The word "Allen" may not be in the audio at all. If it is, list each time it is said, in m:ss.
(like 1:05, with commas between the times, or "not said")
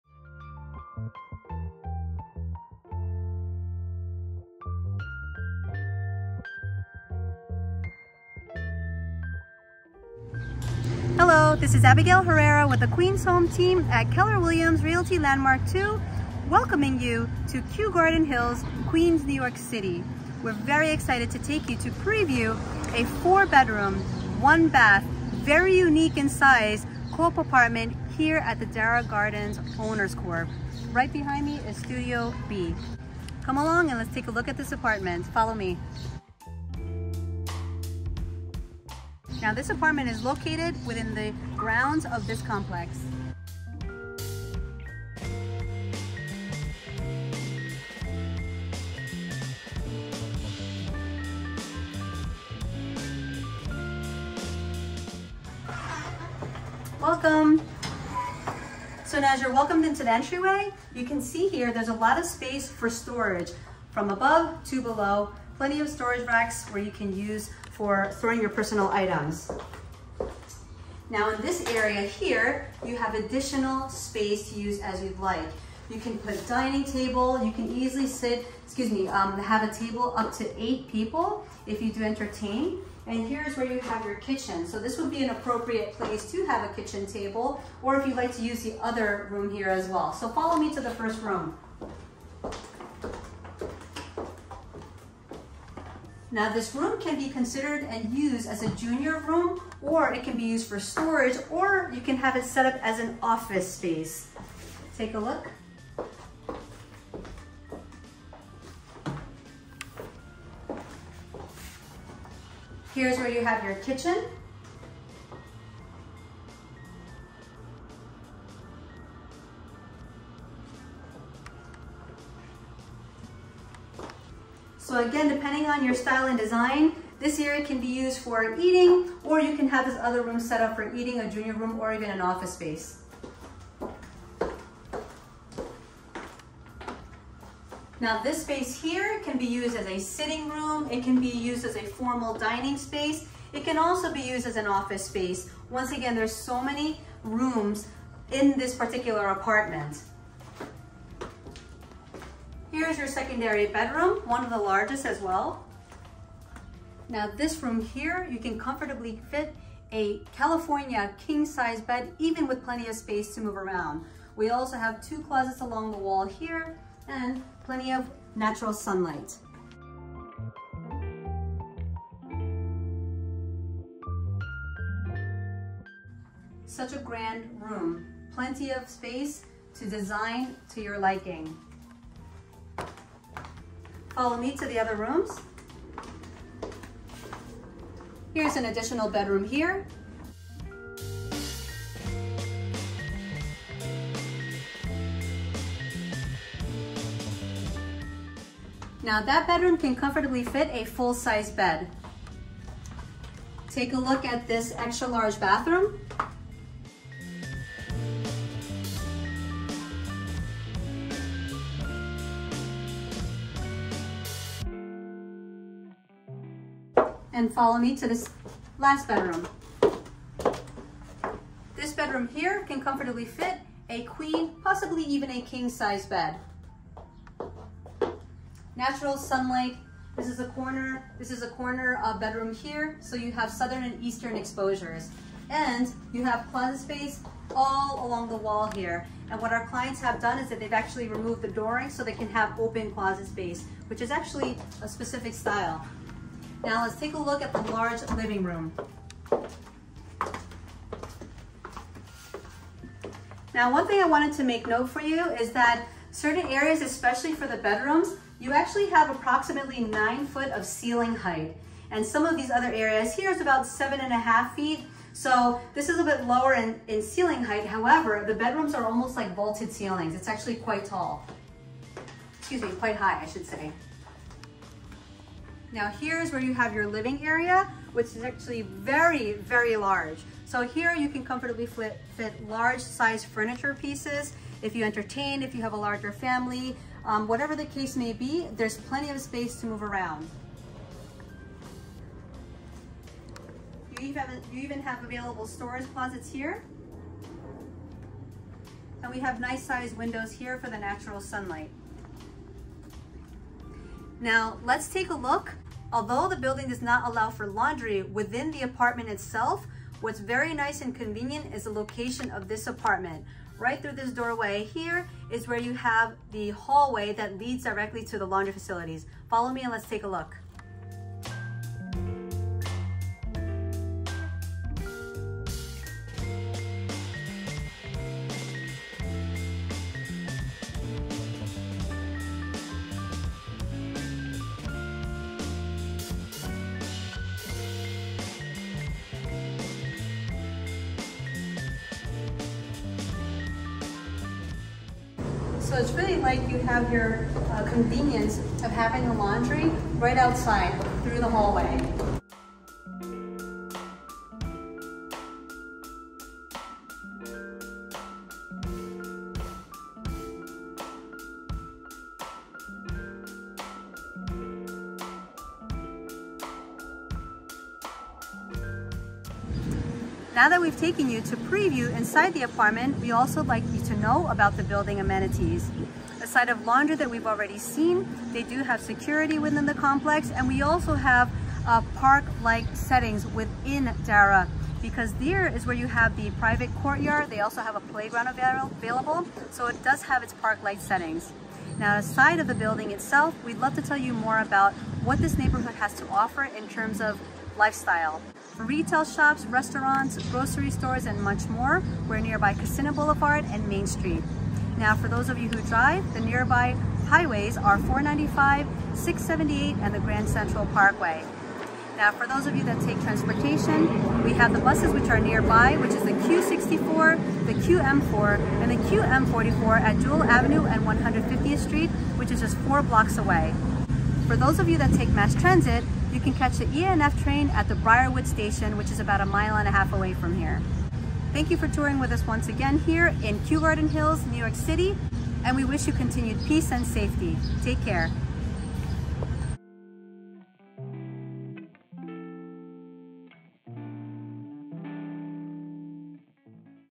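not said.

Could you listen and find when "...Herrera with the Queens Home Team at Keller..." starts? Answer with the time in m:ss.
0:12.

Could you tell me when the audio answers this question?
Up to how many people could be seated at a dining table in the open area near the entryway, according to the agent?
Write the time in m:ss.
1:20.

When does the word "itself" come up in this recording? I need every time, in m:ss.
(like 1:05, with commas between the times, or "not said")
5:09, 6:32.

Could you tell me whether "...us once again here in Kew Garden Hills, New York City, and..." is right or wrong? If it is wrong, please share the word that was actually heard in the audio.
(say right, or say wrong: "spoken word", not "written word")
right.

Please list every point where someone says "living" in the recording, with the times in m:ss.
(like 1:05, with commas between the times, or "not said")
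4:08, 4:36.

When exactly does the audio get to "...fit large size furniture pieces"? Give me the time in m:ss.
4:42.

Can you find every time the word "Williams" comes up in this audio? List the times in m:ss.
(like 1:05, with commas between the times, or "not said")
0:14.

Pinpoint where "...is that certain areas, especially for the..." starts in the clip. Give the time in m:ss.
4:15.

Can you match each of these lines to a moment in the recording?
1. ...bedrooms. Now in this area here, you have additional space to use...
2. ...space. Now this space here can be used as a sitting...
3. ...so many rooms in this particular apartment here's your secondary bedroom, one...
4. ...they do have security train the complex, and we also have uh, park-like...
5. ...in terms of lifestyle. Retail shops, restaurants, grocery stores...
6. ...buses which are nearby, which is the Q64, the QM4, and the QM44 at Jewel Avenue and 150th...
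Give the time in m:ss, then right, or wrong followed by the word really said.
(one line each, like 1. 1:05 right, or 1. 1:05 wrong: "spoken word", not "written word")
1. 1:08 wrong: "items", not "bedrooms"
2. 2:12 right
3. 2:26 right
4. 6:18 wrong: "within", not "train"
5. 6:36 right
6. 6:54 right.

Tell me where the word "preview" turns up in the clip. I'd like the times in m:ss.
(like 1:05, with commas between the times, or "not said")
0:21, 6:11.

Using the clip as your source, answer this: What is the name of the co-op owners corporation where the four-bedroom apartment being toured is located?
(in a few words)
Dara Gardens Owners Corp.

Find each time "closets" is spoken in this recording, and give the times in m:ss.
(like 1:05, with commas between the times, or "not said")
2:45, 3:56, 4:02, 4:55.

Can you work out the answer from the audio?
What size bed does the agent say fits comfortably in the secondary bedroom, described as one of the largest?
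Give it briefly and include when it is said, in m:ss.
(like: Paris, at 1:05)
California king, at 2:40.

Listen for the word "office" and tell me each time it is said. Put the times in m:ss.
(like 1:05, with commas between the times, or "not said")
1:43, 2:12, 2:24.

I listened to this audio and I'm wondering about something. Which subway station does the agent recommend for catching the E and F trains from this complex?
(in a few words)
Briarwood Station.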